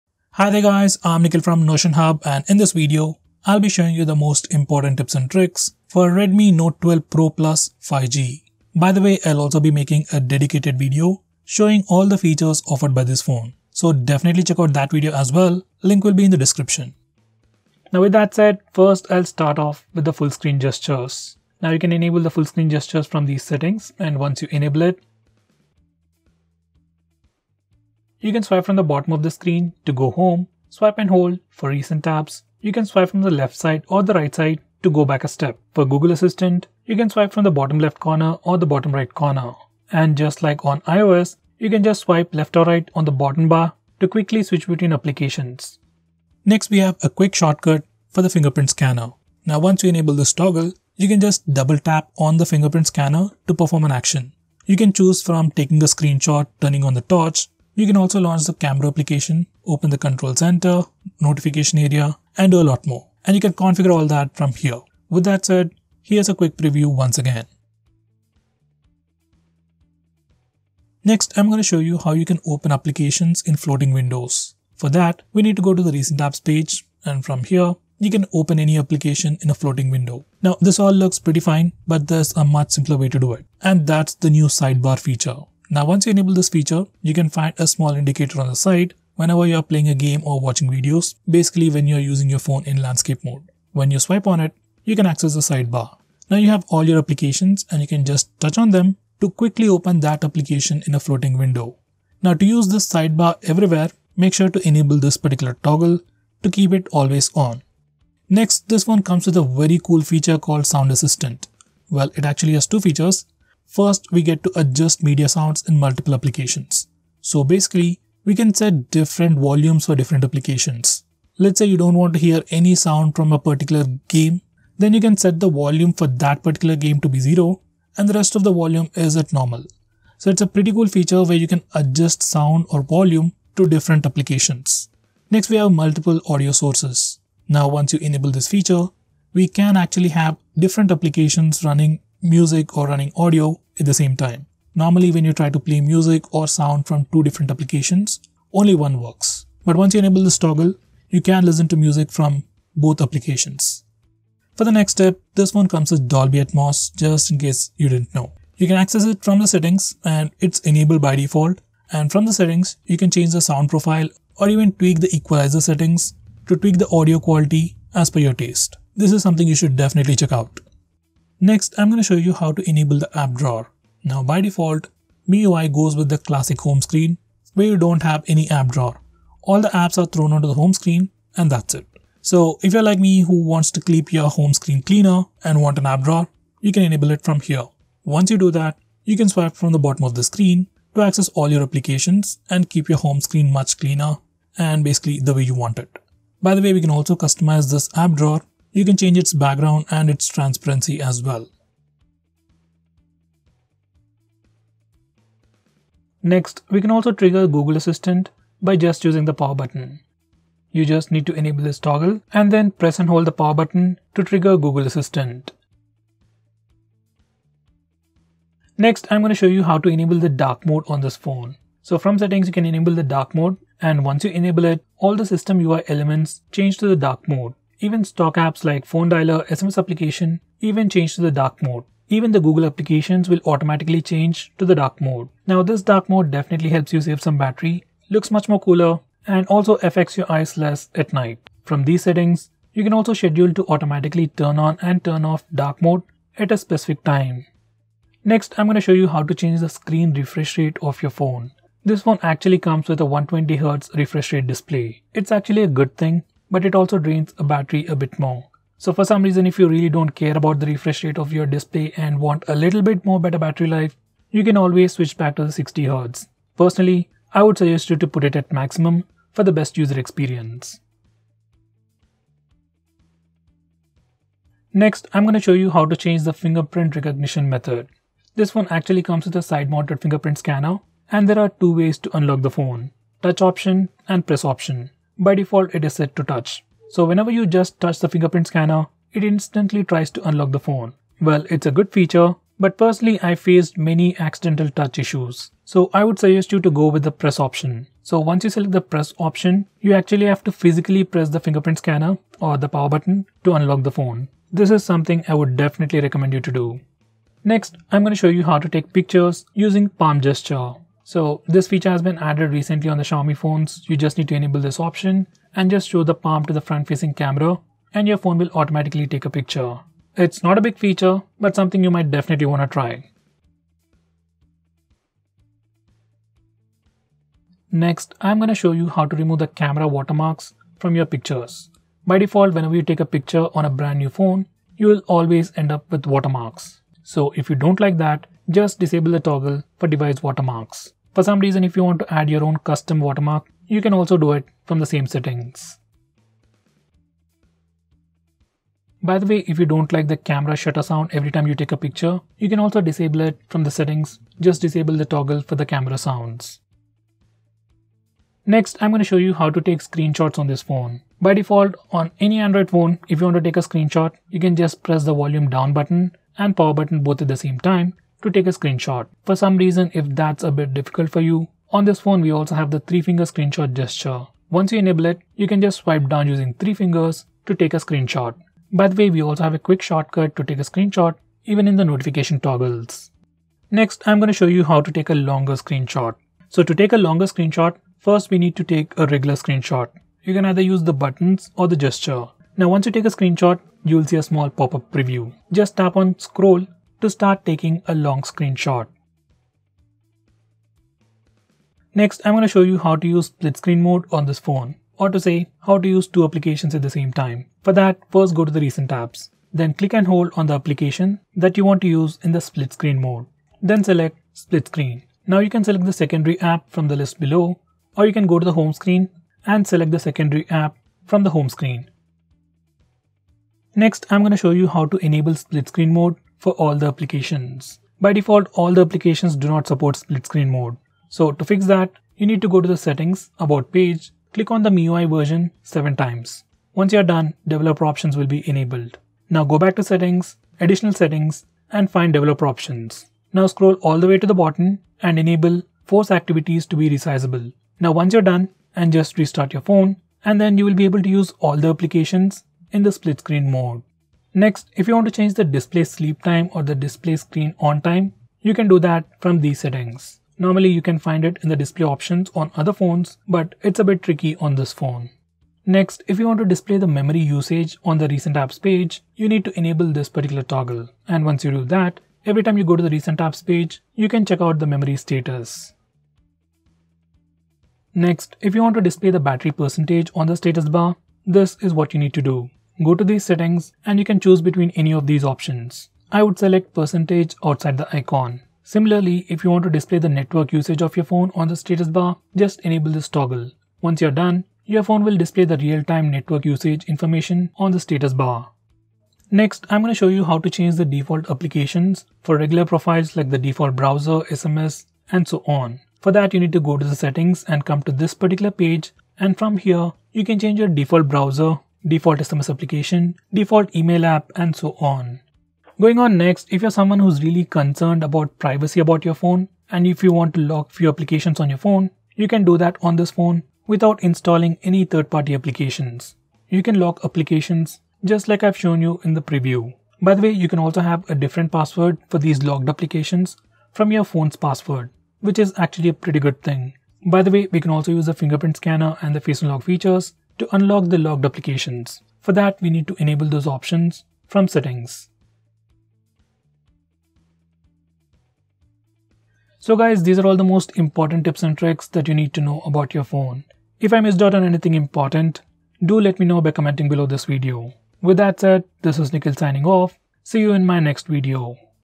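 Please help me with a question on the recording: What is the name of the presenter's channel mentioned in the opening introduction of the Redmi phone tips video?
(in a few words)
Notion Hub.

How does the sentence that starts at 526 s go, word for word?
You can lock applications just like I've shown you in the preview.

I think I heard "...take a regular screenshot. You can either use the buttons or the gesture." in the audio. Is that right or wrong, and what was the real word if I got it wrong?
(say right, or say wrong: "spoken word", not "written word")
right.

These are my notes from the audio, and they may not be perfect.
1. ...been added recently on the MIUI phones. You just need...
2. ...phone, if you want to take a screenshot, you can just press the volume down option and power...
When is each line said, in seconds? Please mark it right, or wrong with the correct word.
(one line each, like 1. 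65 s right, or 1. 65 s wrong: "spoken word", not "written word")
1. 312 s wrong: "Xiaomi", not "MIUI"
2. 362 s wrong: "button", not "option".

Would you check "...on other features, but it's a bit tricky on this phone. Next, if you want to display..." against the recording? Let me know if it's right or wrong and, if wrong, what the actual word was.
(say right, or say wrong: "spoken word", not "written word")
wrong: "phones", not "features".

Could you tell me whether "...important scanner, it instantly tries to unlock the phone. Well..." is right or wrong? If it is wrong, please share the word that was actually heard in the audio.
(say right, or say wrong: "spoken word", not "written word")
wrong: "fingerprint", not "important".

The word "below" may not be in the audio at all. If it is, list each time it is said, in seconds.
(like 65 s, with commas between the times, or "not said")
417 s, 556 s.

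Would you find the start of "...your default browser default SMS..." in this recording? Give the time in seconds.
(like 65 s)
510 s.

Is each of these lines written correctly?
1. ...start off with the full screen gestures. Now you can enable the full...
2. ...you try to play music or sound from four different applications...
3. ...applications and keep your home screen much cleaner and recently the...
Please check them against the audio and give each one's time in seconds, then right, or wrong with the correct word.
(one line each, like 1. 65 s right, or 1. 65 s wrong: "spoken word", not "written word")
1. 19 s right
2. 145 s wrong: "two", not "four"
3. 191 s wrong: "basically", not "recently".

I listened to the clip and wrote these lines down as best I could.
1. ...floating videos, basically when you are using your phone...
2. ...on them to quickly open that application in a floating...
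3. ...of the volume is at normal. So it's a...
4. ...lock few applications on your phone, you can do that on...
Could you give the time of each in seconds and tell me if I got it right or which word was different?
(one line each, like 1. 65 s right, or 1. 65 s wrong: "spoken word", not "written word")
1. 90 s wrong: "watching", not "floating"
2. 98 s right
3. 128 s right
4. 520 s right.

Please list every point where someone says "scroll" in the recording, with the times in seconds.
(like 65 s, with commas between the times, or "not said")
396 s, 443 s.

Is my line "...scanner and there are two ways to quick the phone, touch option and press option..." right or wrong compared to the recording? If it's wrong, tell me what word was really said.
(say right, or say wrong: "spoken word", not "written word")
wrong: "unlock", not "quick".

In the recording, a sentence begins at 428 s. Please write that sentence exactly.
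By default, all the applications do not support split screen mode.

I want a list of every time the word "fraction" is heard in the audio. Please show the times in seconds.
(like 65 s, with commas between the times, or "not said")
not said.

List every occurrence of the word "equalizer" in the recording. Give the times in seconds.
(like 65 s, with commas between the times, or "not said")
165 s.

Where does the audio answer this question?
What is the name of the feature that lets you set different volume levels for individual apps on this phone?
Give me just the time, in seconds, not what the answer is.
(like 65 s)
110 s.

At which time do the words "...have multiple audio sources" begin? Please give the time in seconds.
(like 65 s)
135 s.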